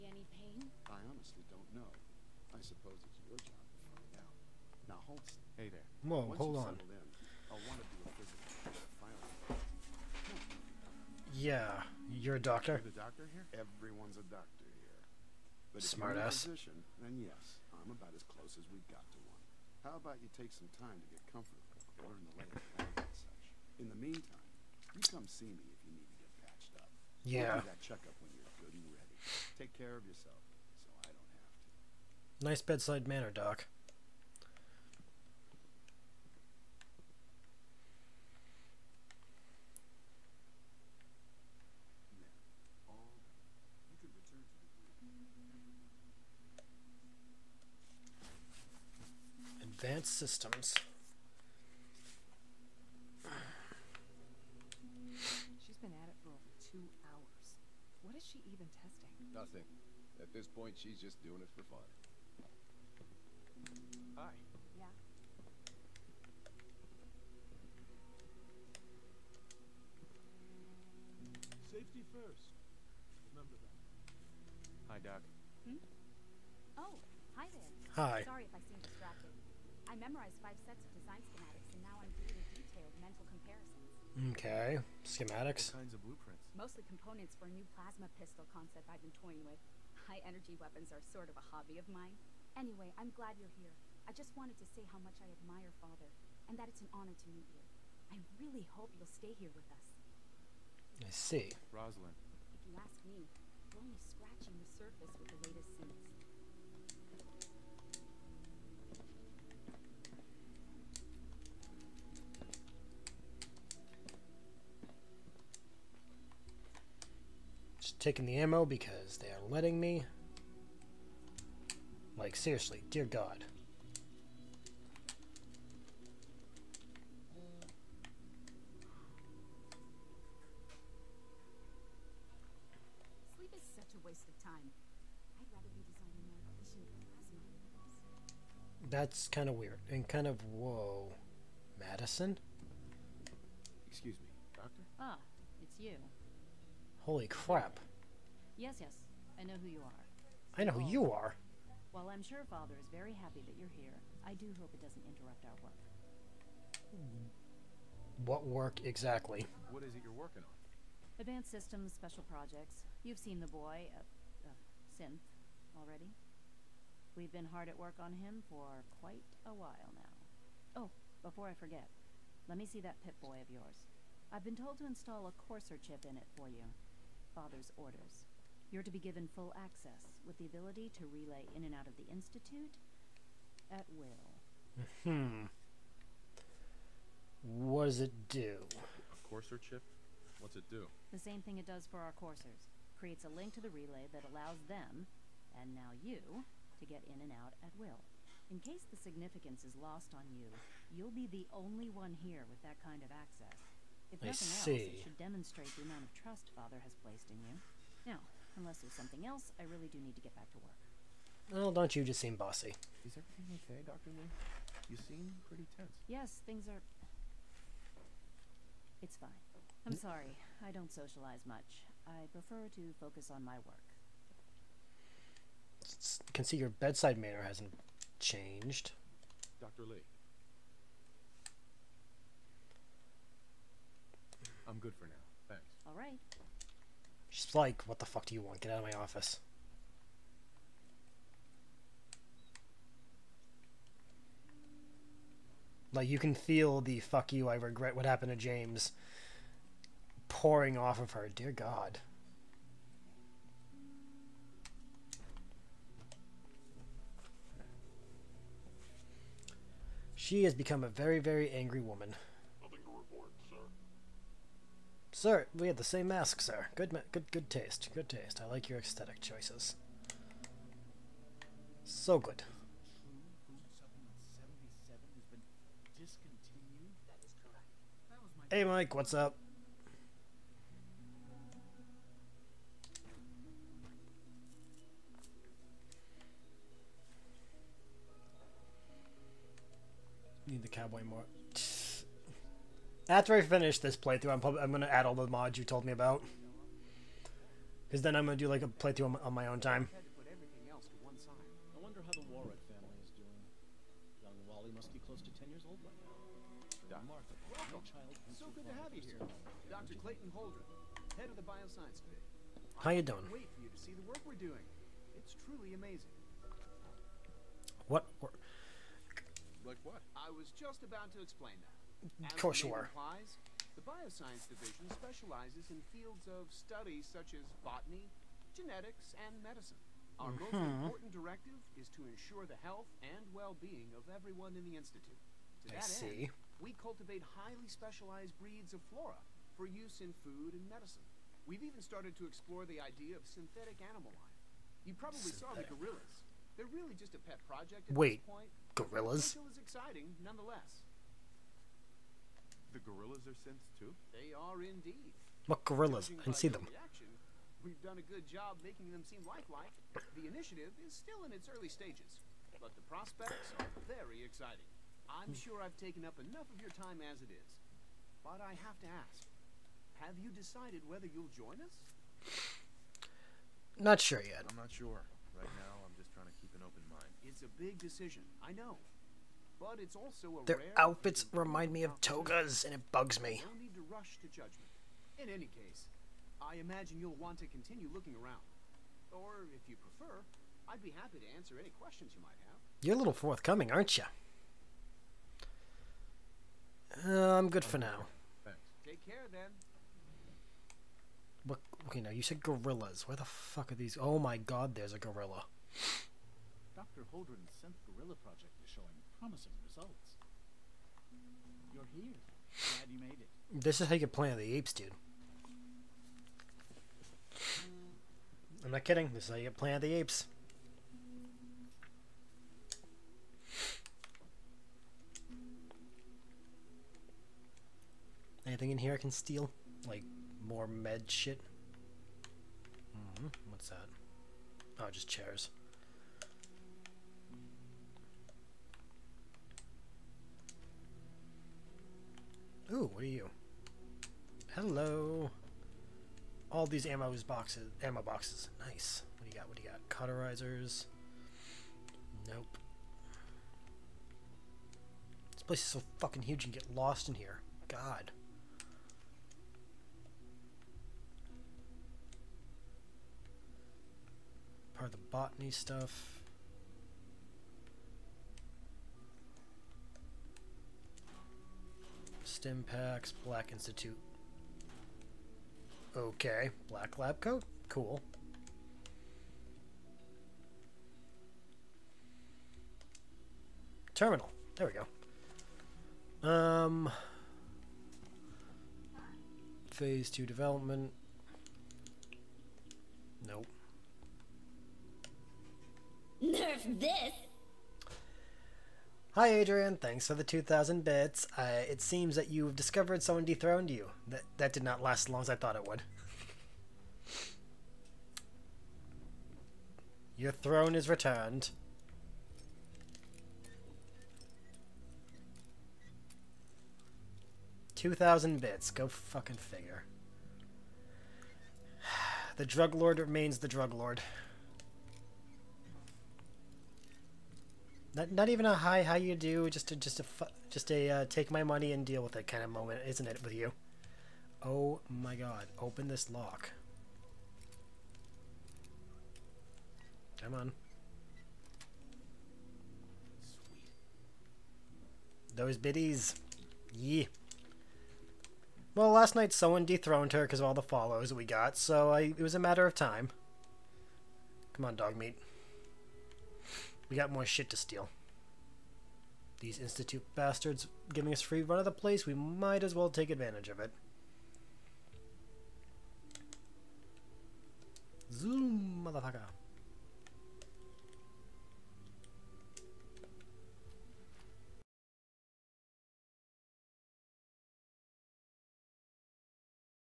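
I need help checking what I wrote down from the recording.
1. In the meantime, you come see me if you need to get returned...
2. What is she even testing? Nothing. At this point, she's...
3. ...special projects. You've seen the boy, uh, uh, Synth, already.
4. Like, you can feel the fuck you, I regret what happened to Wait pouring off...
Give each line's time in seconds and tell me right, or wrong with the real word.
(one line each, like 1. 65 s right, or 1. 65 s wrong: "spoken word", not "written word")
1. 23 s wrong: "patched", not "returned"
2. 58 s right
3. 161 s right
4. 245 s wrong: "James", not "Wait".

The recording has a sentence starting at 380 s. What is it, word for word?
Their outfits remind me of togas, and it bugs me.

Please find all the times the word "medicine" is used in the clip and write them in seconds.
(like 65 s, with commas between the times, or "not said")
329 s, 340 s.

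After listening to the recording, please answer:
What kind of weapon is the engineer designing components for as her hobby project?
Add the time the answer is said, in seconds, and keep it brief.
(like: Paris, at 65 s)
plasma pistol, at 87 s.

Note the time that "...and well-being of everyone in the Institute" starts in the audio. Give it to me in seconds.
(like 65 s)
333 s.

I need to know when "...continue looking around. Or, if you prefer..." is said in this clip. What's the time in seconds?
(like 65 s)
387 s.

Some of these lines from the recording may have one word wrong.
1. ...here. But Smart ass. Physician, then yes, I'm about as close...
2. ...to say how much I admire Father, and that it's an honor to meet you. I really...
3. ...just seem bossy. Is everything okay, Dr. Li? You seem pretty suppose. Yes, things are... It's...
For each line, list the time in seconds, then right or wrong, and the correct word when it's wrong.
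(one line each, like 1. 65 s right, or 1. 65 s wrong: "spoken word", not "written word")
1. 14 s right
2. 94 s right
3. 212 s wrong: "tense", not "suppose".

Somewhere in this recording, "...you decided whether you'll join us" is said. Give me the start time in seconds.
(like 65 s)
370 s.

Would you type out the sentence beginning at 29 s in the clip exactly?
Take care of yourself, so I don't have to.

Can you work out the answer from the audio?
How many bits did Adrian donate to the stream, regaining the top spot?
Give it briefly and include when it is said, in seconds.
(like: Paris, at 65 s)
2,000, at 500 s.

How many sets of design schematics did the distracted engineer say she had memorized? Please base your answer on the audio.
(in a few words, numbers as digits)
5.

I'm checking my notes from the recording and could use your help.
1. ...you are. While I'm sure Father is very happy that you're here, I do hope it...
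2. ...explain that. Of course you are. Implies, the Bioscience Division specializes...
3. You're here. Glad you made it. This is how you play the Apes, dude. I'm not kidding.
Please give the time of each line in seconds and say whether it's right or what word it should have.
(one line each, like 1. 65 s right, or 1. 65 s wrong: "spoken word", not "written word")
1. 150 s right
2. 321 s right
3. 411 s right.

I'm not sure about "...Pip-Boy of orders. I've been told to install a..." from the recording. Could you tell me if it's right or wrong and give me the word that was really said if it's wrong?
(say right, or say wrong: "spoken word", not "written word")
wrong: "yours", not "orders".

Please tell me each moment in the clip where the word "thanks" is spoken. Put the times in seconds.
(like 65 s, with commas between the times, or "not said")
235 s, 398 s, 499 s.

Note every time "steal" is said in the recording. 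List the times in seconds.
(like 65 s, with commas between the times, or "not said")
429 s, 557 s.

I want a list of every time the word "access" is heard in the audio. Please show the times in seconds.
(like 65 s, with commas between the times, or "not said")
179 s, 203 s.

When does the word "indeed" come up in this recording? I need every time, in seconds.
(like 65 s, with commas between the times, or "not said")
354 s.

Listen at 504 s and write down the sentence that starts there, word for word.
That, that did not last as long as I thought it would.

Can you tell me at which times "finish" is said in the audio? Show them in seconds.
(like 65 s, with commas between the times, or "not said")
293 s.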